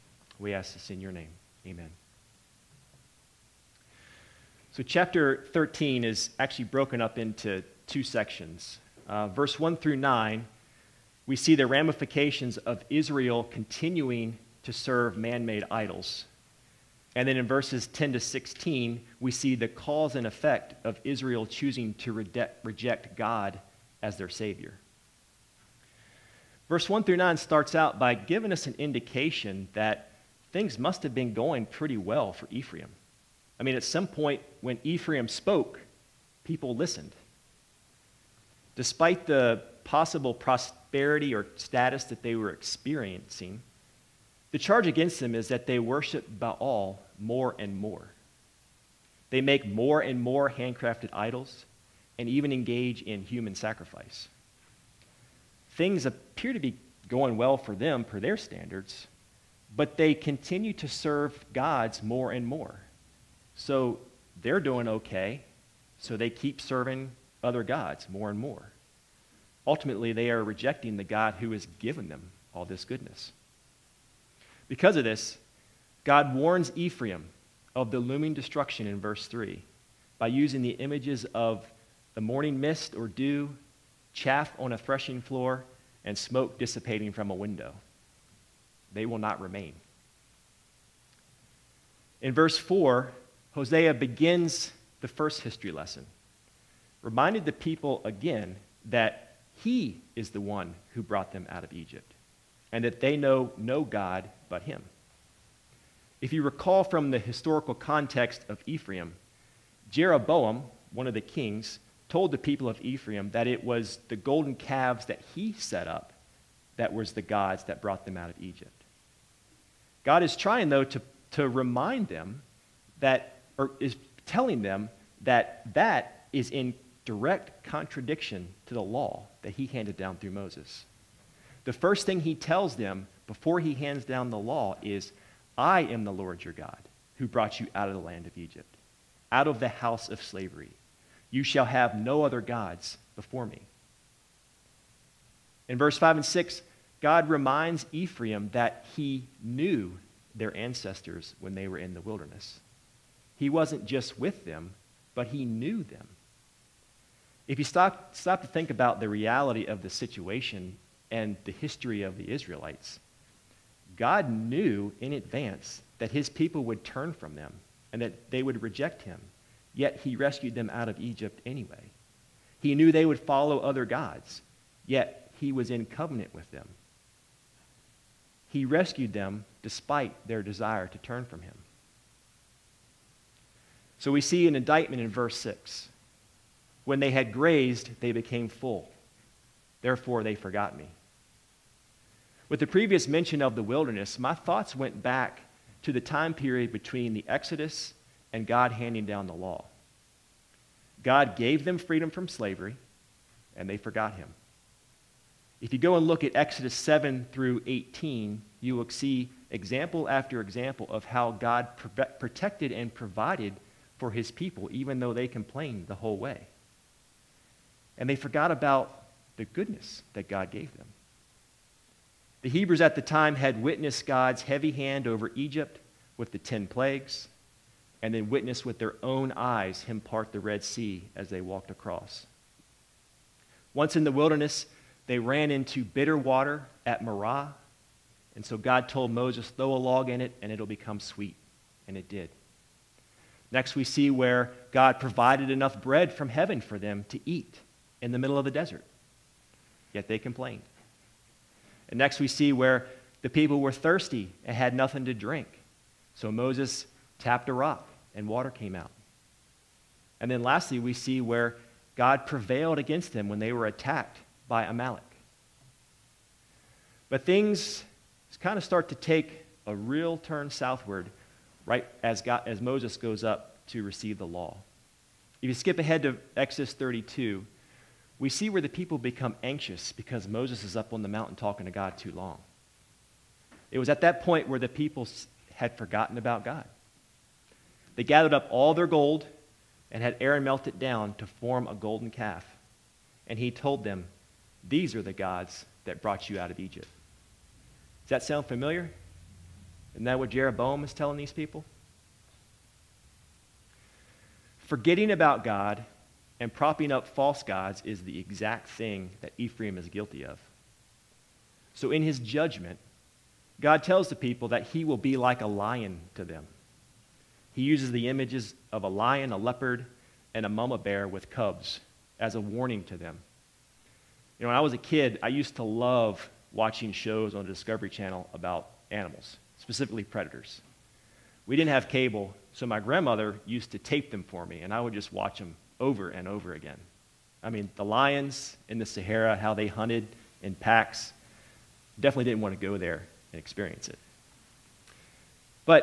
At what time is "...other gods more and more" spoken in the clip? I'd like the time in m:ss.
1:07.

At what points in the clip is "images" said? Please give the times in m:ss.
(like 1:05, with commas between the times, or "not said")
1:20, 5:18.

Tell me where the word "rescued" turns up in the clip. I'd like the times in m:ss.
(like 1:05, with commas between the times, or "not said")
2:50, 2:58.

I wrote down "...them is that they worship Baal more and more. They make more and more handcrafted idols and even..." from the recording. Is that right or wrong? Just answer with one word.
right.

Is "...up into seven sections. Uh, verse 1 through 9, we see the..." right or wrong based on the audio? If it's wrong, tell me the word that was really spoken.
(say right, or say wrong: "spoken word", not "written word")
wrong: "two", not "seven".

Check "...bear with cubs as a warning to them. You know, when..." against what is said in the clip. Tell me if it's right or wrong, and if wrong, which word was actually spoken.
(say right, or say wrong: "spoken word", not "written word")
right.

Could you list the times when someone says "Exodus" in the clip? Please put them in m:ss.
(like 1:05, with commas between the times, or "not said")
3:17, 3:26, 4:36.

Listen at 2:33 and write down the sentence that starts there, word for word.
He wasn't just with them, but he knew them.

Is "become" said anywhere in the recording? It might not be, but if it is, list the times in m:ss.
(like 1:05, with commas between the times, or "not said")
4:00, 4:38.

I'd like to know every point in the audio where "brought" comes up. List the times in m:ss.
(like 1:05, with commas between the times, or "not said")
1:41, 1:57, 2:17, 4:56.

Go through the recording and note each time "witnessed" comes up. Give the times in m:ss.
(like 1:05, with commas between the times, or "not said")
3:43, 3:48.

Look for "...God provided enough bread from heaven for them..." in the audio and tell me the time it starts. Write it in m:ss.
4:04.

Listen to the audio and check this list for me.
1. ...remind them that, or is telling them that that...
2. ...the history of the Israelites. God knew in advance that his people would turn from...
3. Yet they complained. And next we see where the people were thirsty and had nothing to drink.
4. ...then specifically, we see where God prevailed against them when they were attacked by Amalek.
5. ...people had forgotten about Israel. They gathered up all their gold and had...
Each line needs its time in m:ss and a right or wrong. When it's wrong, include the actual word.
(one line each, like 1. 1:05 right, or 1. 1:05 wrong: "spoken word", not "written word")
1. 2:01 right
2. 2:41 right
3. 4:09 right
4. 4:20 wrong: "lastly", not "specifically"
5. 4:44 wrong: "God", not "Israel".